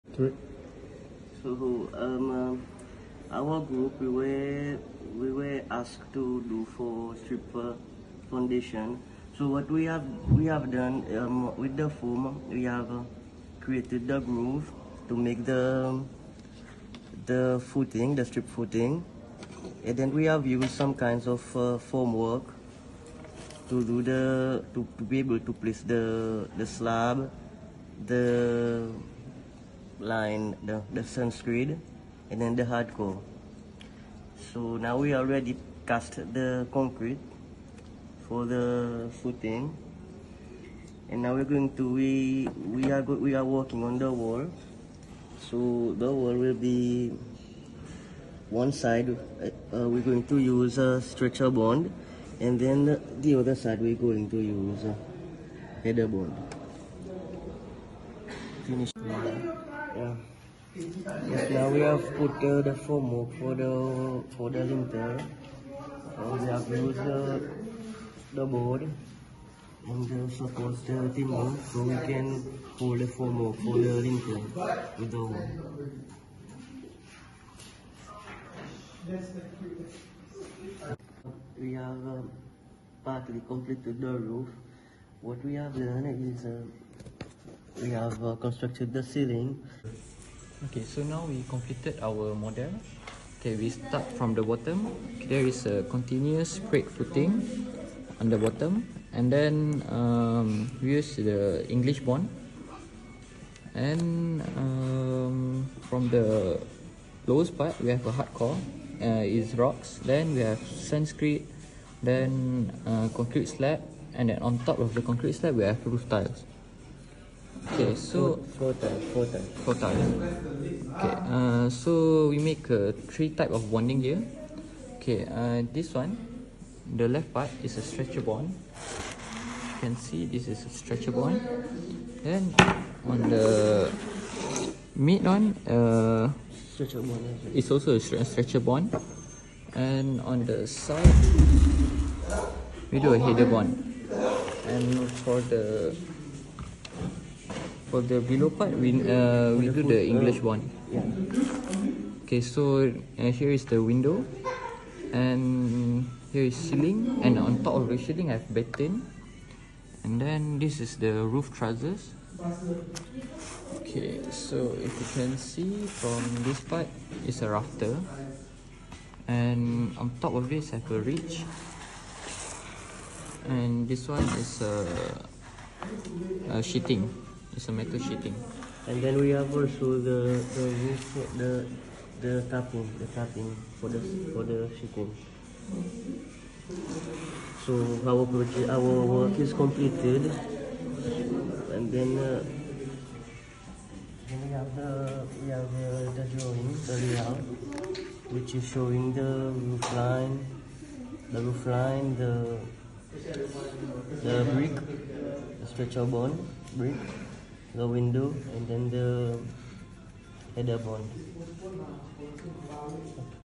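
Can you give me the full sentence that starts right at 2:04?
Okay, uh, this one, the left part is a stretcher bond.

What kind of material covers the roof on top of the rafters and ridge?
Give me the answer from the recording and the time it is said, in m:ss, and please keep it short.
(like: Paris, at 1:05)
Metal sheeting, at 2:57.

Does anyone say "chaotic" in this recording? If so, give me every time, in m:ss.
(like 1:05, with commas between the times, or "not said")
not said.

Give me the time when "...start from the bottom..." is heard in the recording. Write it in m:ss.
1:33.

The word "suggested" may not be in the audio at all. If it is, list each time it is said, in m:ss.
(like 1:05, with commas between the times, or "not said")
not said.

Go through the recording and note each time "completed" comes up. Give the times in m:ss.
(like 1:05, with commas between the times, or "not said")
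1:23, 1:31, 3:09.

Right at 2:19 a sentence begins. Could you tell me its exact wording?
And on the side, we do a header bond.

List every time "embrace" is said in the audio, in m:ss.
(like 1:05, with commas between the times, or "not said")
not said.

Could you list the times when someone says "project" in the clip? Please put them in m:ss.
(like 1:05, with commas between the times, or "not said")
3:08.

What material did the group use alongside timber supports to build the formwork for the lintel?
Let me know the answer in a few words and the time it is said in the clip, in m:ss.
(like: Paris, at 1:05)
Board, at 1:08.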